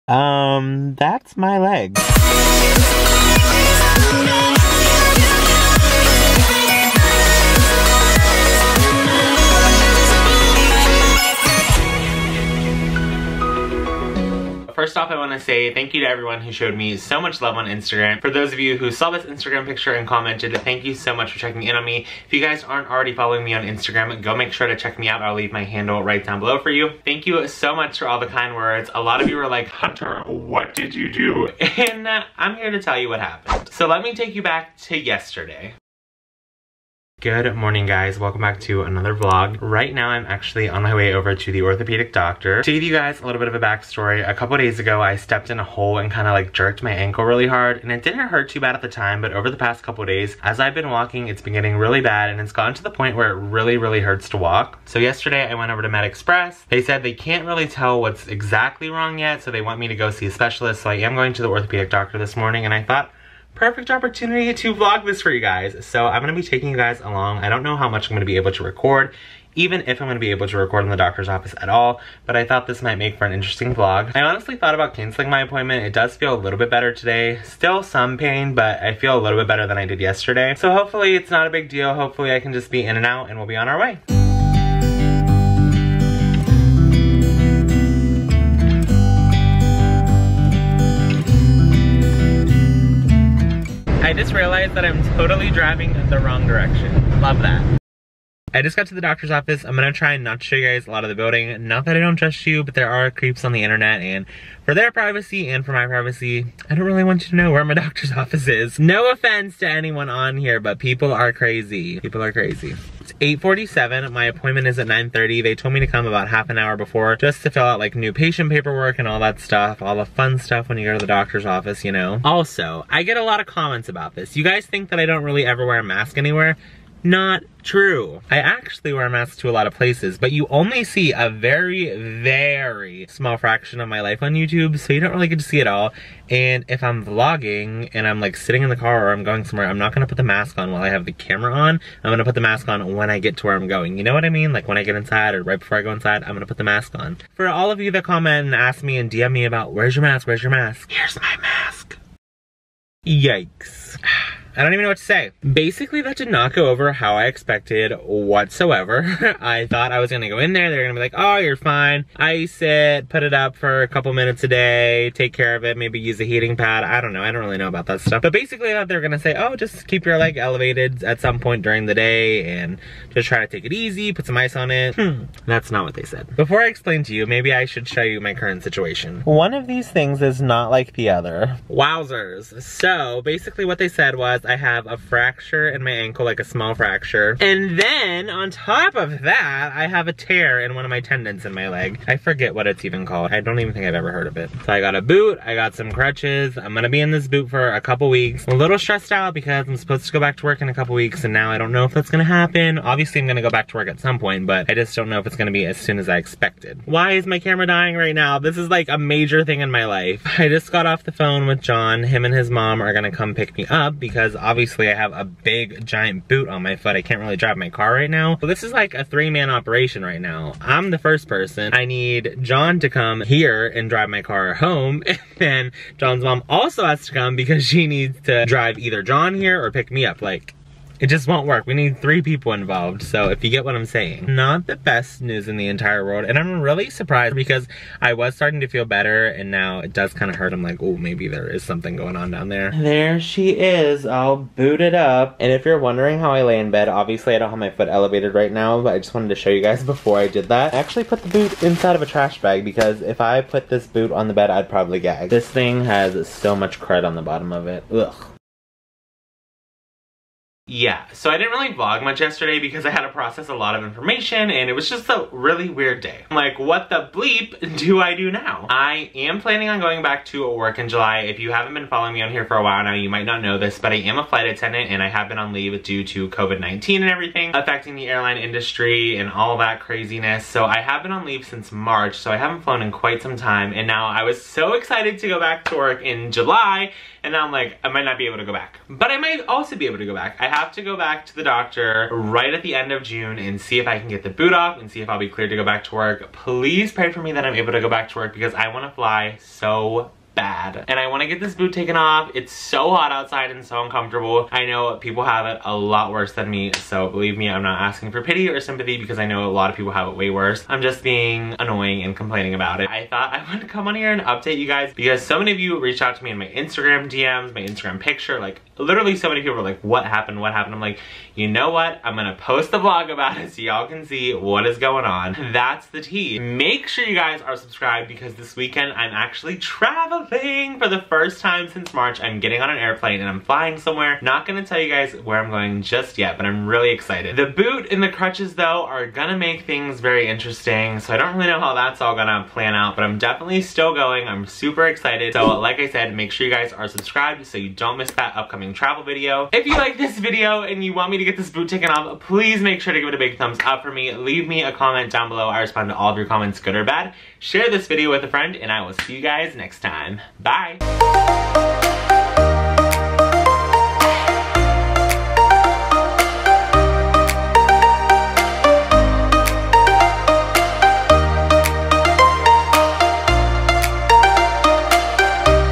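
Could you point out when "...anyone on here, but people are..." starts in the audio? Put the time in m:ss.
1:49.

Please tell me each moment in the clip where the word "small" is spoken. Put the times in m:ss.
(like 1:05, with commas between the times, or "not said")
2:13, 3:06.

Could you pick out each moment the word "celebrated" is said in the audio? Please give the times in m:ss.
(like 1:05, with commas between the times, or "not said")
not said.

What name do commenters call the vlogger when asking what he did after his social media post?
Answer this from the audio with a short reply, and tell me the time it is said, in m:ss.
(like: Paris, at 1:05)
Hunter, at 0:29.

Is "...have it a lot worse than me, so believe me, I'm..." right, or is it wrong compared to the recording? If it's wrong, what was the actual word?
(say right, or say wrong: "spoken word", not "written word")
right.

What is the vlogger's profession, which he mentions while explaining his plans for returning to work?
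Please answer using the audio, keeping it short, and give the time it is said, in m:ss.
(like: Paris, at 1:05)
Flight attendant, at 4:34.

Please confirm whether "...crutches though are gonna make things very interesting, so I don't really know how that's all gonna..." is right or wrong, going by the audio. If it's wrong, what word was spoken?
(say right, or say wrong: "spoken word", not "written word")
right.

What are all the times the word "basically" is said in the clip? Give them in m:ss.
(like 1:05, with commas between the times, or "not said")
2:35, 2:48, 3:03.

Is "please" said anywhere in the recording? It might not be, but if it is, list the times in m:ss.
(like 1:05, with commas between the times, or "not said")
4:56, 5:52.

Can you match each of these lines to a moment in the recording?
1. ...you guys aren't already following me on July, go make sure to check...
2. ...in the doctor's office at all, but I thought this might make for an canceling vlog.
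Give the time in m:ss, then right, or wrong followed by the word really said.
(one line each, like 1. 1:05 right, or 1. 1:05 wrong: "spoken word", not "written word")
1. 0:22 wrong: "Instagram", not "July"
2. 1:10 wrong: "interesting", not "canceling".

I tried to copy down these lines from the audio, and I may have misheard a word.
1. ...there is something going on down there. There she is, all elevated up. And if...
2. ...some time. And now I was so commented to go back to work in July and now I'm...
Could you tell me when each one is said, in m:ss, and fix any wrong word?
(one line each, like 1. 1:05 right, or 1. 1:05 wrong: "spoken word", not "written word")
1. 4:01 wrong: "booted", not "elevated"
2. 4:43 wrong: "excited", not "commented".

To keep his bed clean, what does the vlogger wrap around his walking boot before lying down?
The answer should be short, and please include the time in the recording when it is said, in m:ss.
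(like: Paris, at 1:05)
Trash bag, at 4:12.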